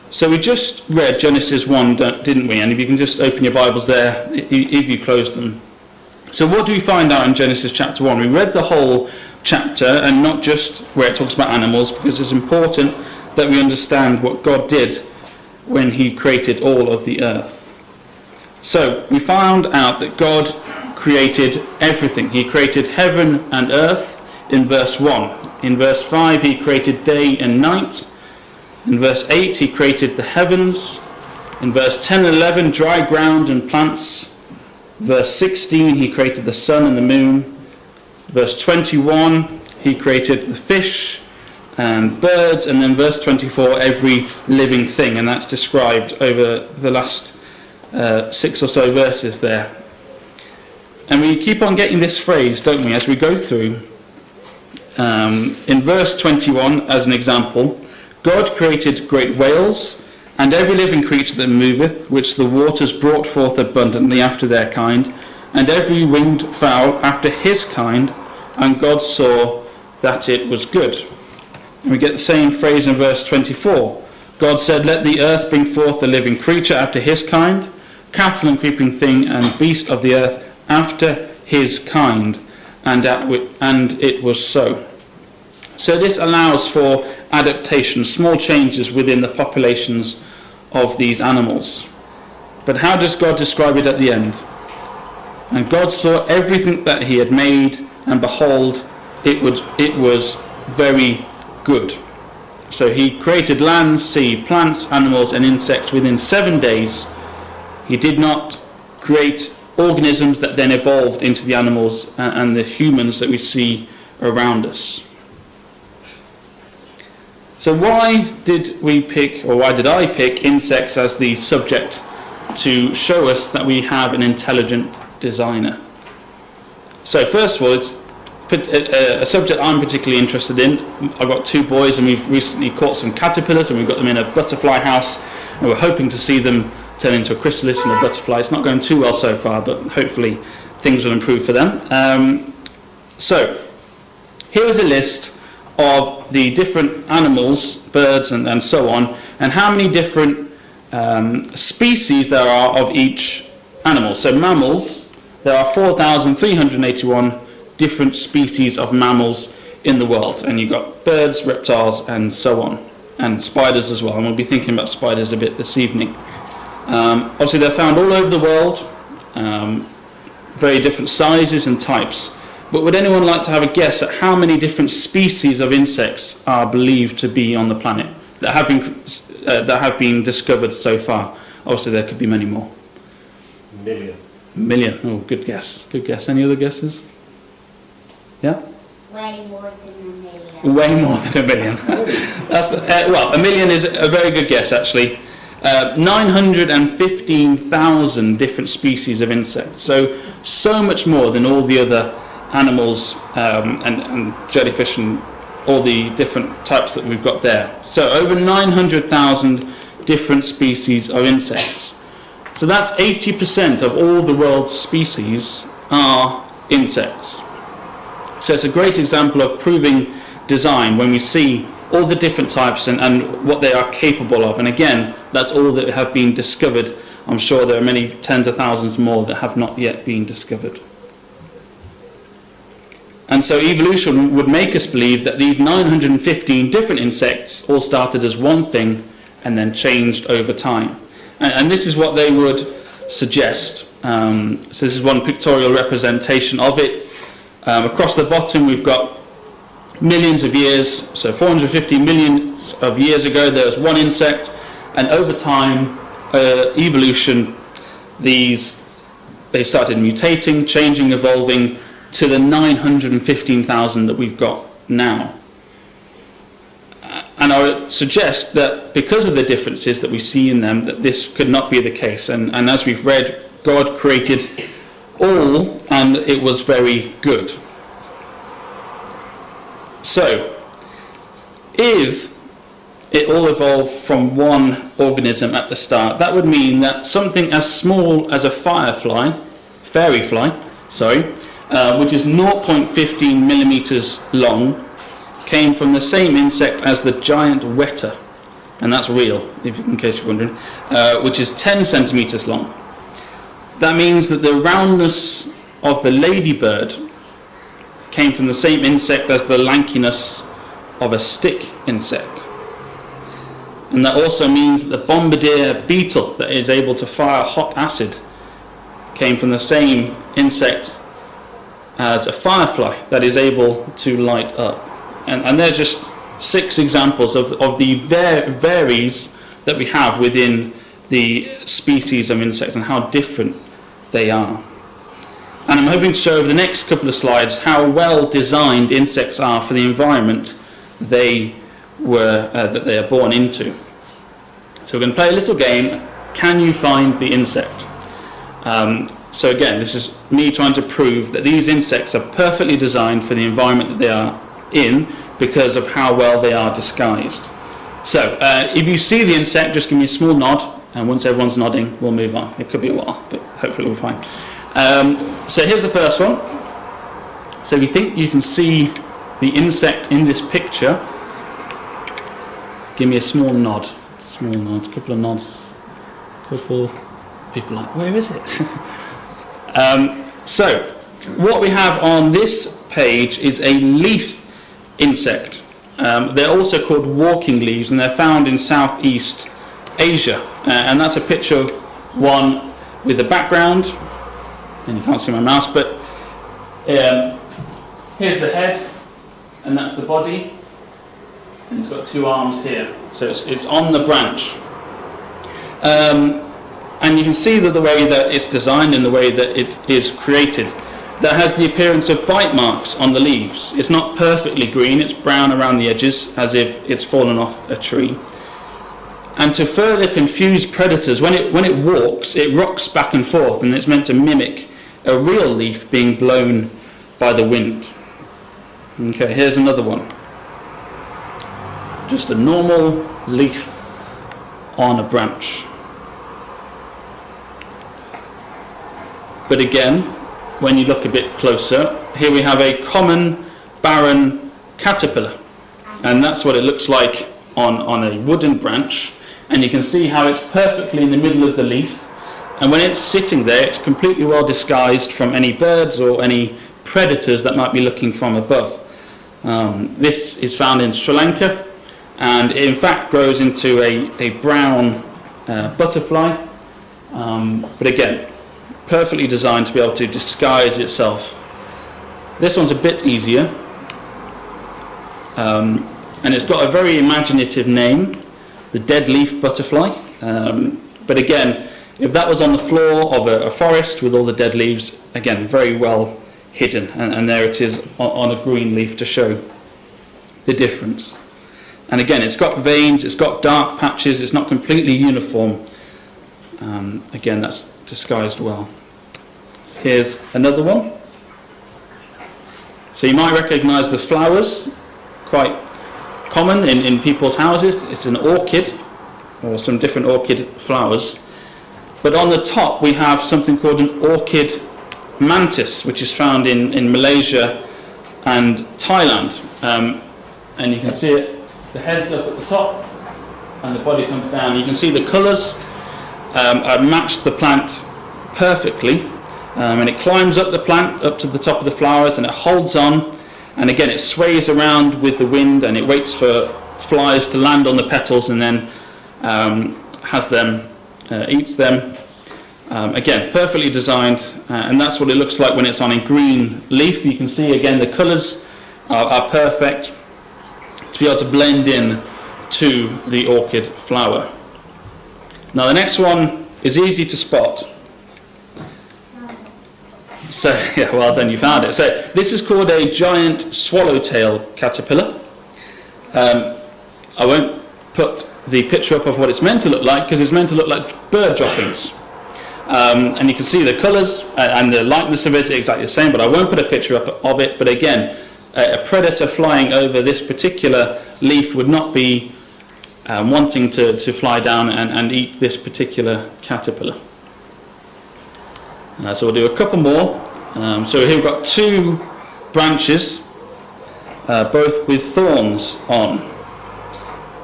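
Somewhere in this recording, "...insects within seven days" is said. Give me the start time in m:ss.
1:45.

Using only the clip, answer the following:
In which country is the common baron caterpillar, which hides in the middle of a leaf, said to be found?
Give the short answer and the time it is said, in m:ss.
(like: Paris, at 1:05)
Sri Lanka, at 7:40.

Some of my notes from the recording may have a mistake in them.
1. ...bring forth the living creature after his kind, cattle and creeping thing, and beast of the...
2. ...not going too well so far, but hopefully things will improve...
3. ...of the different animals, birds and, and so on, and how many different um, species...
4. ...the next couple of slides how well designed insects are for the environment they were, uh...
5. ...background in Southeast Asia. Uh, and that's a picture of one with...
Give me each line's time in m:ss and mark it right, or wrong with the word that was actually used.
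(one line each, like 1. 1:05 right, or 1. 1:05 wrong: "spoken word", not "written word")
1. 1:15 right
2. 2:18 right
3. 2:25 right
4. 5:36 right
5. 6:28 wrong: "found", not "background".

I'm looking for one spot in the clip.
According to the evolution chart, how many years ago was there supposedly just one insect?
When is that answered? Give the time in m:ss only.
4:11.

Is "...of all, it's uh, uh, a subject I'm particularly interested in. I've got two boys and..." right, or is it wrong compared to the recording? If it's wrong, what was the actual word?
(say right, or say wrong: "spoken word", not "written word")
right.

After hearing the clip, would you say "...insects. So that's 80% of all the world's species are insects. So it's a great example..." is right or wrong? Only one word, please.
right.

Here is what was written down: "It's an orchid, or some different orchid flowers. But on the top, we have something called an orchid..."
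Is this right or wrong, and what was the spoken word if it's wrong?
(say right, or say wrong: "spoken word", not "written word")
right.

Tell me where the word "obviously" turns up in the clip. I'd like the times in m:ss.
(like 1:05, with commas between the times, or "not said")
2:47, 3:01.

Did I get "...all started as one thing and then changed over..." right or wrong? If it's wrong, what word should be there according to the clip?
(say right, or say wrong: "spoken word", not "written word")
right.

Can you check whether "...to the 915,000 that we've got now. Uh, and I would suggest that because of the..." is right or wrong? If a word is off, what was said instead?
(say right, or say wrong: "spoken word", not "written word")
right.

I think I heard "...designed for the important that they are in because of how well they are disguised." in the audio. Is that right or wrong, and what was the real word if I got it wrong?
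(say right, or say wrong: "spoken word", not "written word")
wrong: "environment", not "important".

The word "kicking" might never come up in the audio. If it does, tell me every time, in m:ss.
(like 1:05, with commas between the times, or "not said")
not said.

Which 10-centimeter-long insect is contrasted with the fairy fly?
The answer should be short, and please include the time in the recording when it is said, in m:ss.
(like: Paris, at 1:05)
giant weta, at 4:57.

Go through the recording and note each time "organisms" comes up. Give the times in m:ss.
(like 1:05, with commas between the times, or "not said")
1:49, 4:44.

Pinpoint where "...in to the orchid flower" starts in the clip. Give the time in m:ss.
9:11.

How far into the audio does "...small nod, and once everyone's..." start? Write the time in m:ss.
6:00.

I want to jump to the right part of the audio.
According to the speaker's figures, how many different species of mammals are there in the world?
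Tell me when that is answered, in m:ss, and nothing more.
2:35.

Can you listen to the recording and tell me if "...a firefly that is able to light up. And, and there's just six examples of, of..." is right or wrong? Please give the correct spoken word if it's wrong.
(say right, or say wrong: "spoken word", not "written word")
right.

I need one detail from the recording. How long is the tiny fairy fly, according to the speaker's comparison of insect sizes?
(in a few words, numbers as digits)
0.15 millimeters.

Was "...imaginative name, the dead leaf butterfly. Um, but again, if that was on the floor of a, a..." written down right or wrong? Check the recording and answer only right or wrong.
right.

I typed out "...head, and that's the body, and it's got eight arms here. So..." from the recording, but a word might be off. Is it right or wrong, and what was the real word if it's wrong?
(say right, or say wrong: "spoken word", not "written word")
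wrong: "two", not "eight".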